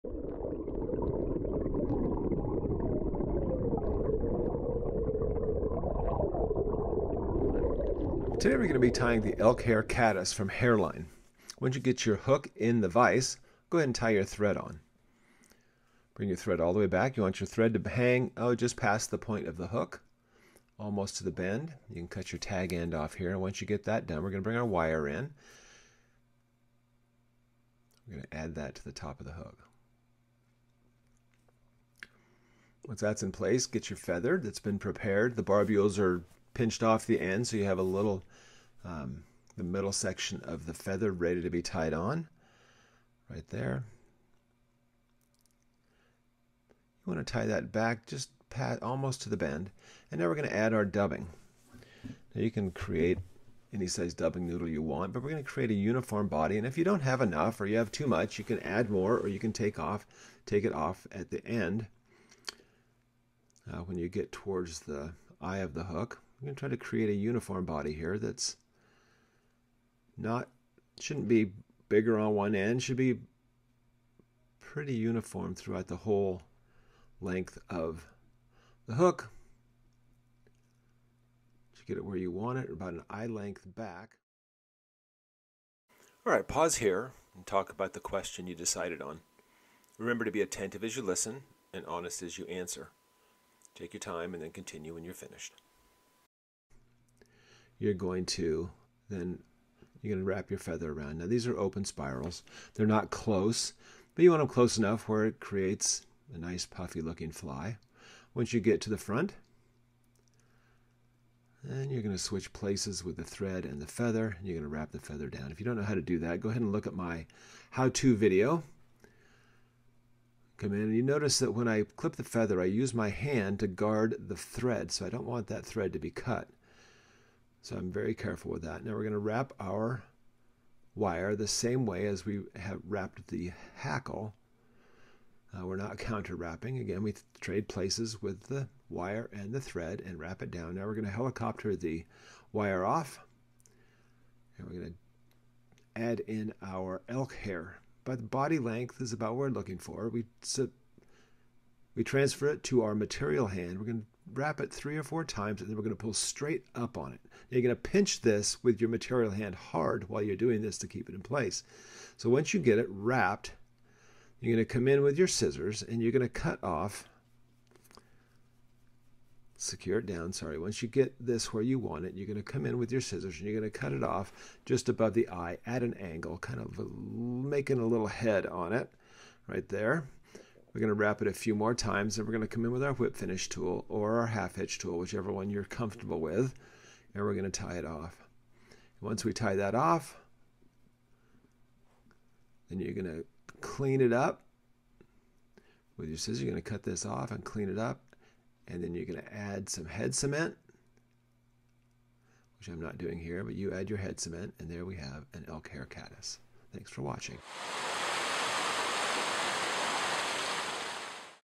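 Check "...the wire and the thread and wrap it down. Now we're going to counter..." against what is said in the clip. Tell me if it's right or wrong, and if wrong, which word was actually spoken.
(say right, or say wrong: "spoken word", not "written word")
wrong: "helicopter", not "counter".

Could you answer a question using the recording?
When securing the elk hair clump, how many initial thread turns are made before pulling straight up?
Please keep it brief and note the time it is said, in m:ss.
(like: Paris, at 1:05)
Three or four, at 2:34.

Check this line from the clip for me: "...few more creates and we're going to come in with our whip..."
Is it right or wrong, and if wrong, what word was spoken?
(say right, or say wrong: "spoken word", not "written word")
wrong: "times", not "creates".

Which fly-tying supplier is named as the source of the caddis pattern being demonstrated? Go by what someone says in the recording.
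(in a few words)
Hareline.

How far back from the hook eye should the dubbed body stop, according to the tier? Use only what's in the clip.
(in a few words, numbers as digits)
About an eye length.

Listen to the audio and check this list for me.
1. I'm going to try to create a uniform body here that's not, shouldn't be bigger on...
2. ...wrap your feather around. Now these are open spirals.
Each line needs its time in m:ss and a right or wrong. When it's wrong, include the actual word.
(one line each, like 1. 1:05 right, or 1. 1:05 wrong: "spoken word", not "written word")
1. 1:06 right
2. 1:40 right.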